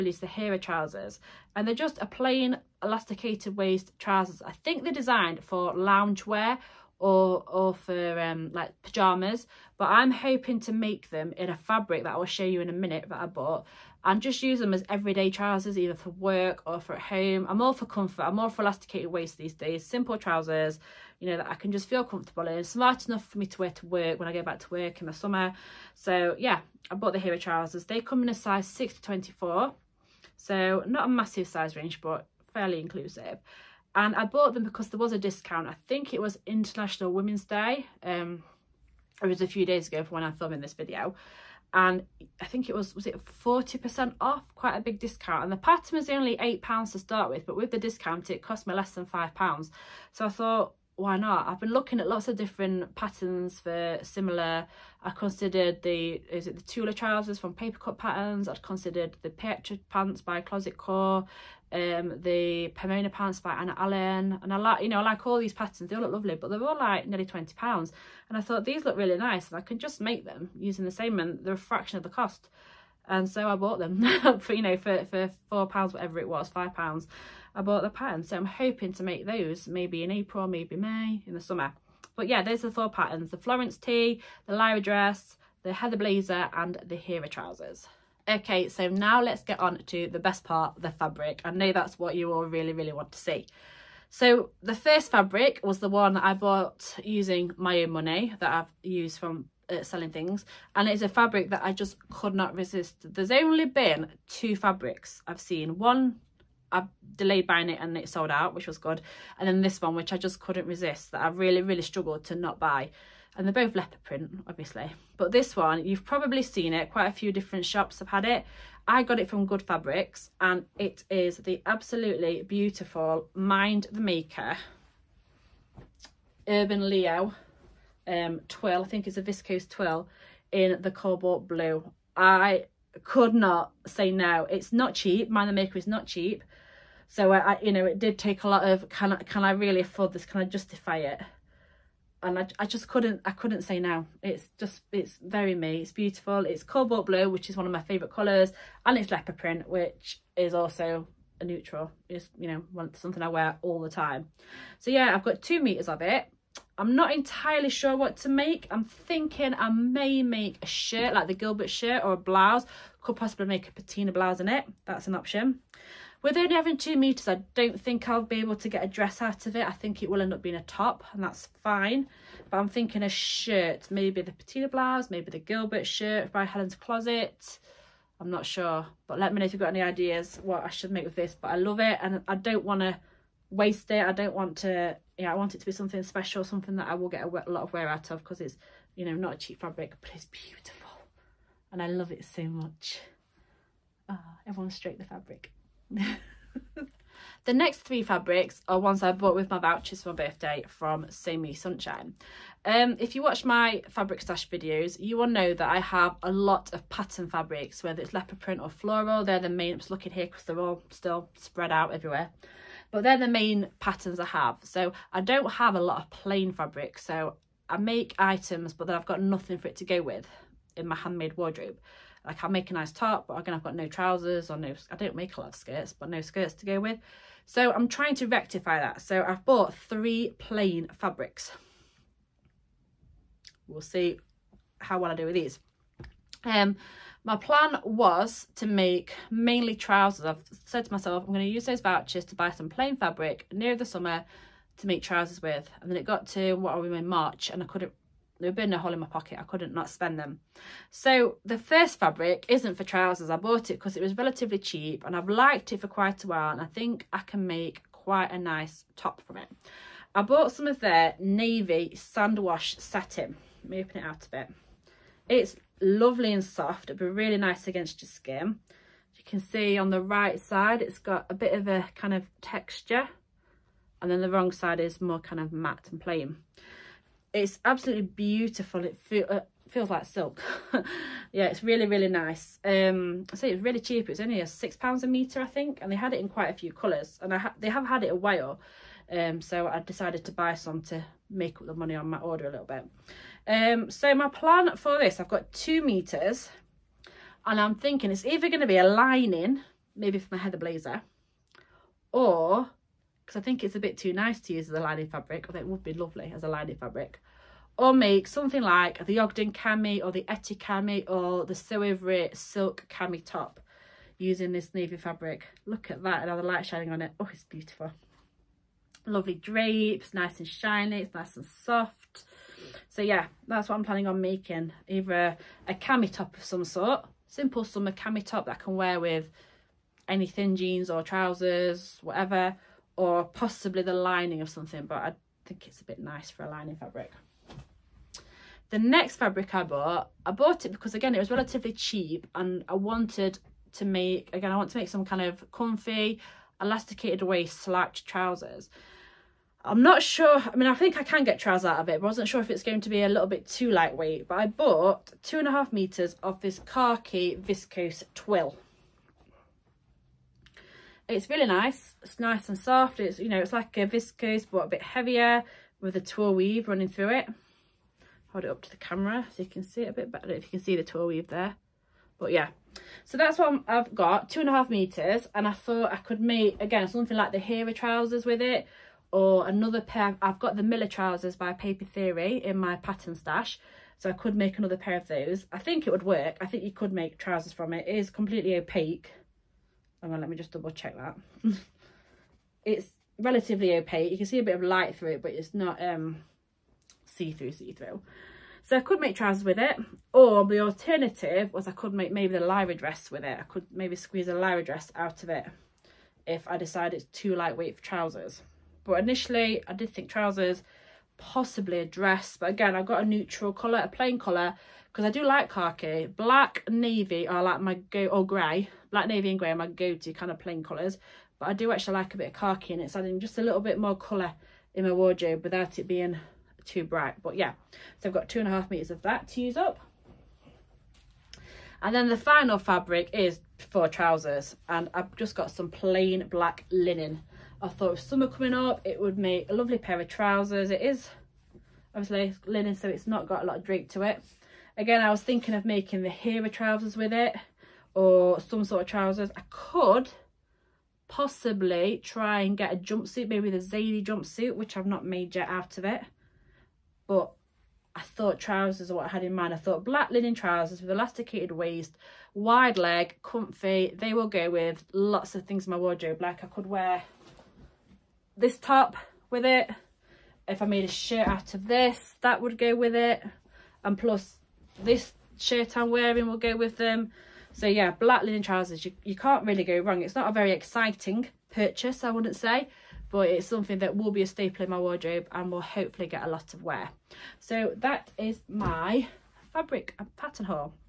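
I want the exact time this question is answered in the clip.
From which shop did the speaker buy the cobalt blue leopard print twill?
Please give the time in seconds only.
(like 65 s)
119 s.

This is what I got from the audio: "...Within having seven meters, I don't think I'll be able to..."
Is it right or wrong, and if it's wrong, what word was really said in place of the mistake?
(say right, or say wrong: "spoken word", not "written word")
wrong: "two", not "seven".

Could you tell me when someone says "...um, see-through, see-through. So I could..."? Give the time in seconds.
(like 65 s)
395 s.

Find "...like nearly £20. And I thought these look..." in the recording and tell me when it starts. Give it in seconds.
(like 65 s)
66 s.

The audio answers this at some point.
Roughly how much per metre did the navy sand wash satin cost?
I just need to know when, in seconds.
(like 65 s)
284 s.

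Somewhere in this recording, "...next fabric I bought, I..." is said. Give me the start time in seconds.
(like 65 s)
338 s.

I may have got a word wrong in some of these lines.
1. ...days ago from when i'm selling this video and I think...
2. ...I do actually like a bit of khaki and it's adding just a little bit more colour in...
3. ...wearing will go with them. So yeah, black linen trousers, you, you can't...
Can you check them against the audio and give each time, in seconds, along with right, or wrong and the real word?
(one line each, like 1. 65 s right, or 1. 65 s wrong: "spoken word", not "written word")
1. 39 s wrong: "filming", not "selling"
2. 421 s right
3. 475 s right.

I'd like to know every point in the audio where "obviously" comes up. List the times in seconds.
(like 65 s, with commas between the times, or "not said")
114 s, 441 s.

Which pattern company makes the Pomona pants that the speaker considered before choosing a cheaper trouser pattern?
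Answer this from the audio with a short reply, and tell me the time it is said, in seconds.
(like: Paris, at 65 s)
Anna Allen, at 63 s.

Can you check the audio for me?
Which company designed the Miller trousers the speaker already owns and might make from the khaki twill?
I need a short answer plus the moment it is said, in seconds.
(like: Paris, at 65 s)
Paper Theory, at 381 s.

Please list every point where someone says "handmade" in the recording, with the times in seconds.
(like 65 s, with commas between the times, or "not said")
220 s.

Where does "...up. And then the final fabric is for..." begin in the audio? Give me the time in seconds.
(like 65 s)
429 s.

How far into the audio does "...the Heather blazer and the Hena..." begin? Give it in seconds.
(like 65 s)
85 s.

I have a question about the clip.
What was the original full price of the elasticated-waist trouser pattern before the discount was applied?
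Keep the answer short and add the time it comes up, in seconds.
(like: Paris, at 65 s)
8 pounds, at 46 s.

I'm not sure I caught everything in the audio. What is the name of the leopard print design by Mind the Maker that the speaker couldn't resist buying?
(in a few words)
Urban Leo.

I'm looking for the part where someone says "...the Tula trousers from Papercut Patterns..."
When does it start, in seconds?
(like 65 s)
56 s.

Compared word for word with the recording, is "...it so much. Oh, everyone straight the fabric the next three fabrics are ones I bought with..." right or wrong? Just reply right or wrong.
right.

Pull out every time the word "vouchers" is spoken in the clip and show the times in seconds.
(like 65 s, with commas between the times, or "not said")
199 s, 241 s.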